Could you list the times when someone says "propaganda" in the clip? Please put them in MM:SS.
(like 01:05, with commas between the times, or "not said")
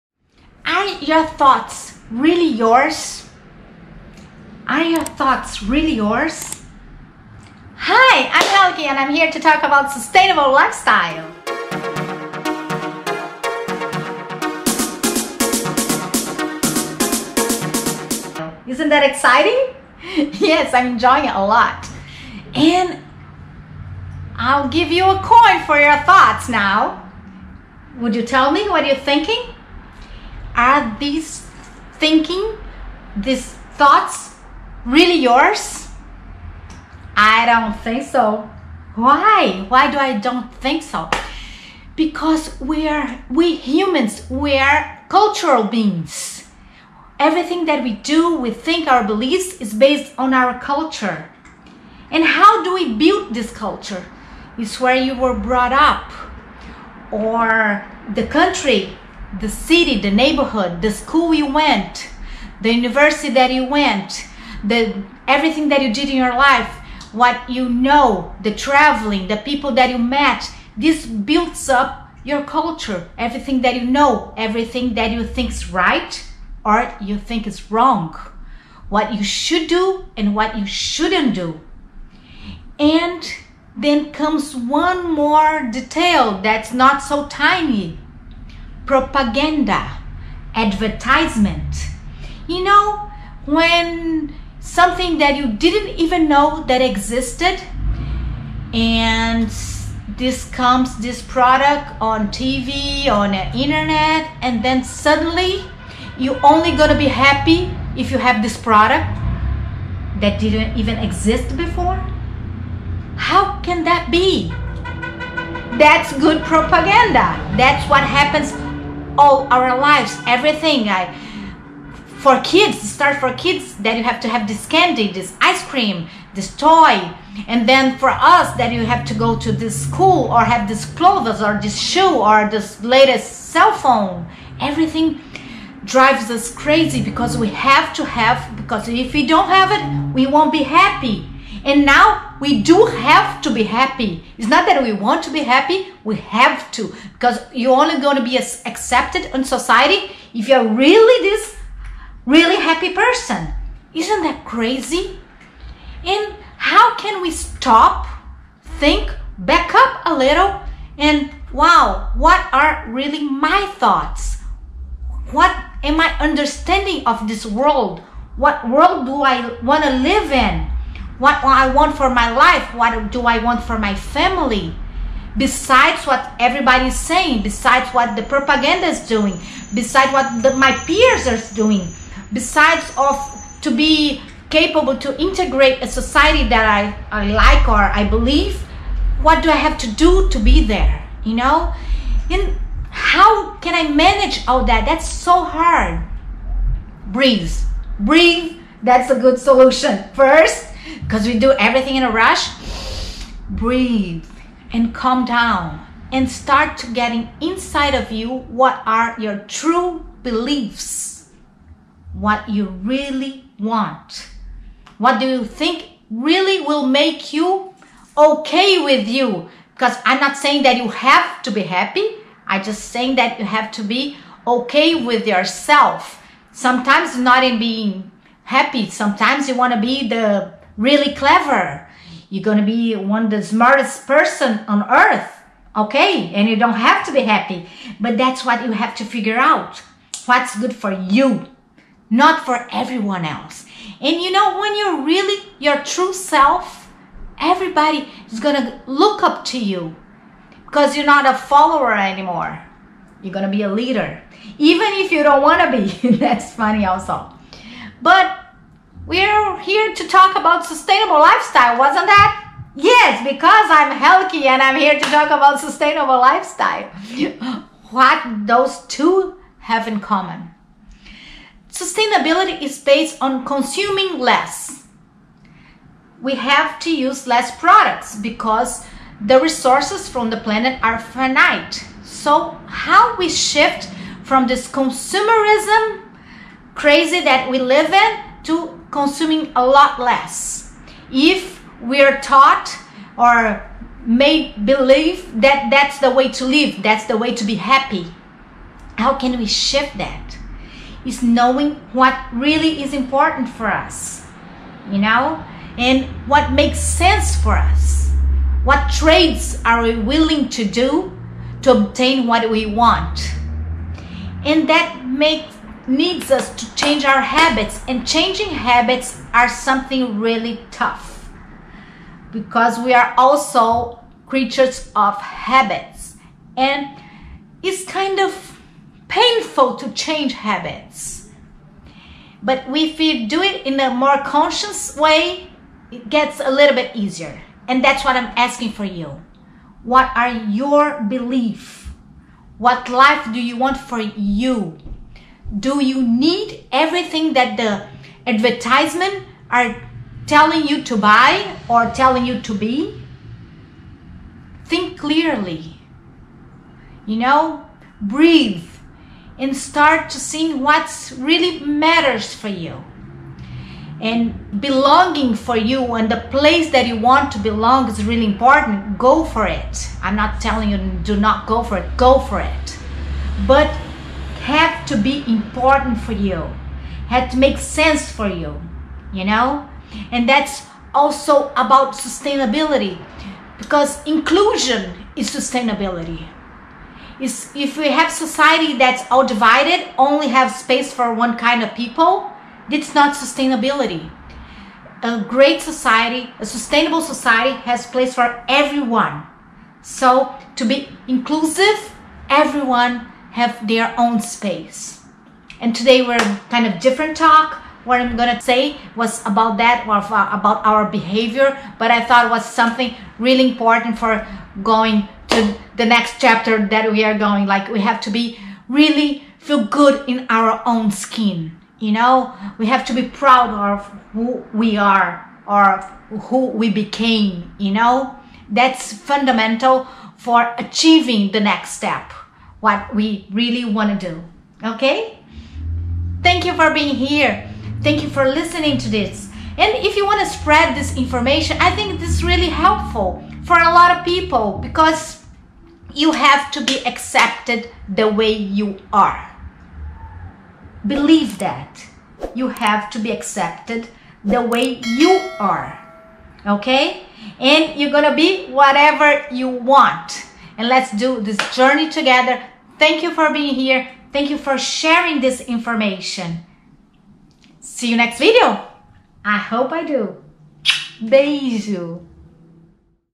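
01:28, 01:56, 02:58.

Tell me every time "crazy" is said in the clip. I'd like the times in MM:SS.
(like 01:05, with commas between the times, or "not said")
02:16, 02:34, 04:46.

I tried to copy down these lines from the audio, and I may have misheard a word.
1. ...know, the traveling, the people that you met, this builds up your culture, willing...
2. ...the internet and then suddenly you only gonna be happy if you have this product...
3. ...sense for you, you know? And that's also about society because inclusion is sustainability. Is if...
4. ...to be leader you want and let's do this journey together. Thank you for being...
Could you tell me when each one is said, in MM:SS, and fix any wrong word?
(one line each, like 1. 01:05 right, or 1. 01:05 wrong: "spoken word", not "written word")
1. 01:07 wrong: "everything", not "willing"
2. 01:43 right
3. 06:17 wrong: "sustainability", not "society"
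4. 07:38 wrong: "whatever", not "leader".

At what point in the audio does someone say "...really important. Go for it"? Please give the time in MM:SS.
06:08.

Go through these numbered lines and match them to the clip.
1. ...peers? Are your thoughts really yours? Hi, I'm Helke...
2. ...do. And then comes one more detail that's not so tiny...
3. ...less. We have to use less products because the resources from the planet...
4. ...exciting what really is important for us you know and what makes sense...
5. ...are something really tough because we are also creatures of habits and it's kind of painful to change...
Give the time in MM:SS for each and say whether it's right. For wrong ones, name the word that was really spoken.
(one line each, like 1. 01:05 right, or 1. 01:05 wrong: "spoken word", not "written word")
1. 00:02 wrong: "yours", not "peers"
2. 01:21 right
3. 04:34 right
4. 05:01 wrong: "knowing", not "exciting"
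5. 05:19 right.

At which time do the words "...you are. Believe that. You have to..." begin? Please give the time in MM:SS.
07:28.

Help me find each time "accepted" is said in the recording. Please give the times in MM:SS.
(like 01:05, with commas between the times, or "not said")
02:28, 07:26, 07:33.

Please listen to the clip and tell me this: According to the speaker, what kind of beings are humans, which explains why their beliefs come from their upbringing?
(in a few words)
Cultural beings.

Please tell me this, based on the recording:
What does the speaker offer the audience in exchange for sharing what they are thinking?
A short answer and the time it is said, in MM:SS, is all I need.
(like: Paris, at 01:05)
A coin, at 00:25.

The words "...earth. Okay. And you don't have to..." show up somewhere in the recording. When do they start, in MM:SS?
03:54.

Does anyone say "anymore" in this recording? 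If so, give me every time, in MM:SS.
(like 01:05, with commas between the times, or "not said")
04:11.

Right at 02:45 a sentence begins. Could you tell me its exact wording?
What am I understanding of this world?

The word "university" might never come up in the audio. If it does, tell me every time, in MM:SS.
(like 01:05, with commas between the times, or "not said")
01:02.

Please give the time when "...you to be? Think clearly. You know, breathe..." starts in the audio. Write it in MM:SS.
05:52.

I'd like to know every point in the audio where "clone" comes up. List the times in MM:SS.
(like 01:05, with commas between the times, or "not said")
not said.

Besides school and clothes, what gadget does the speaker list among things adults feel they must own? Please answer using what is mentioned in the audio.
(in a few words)
Latest cell phone.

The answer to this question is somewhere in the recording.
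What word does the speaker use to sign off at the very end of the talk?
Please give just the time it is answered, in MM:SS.
07:51.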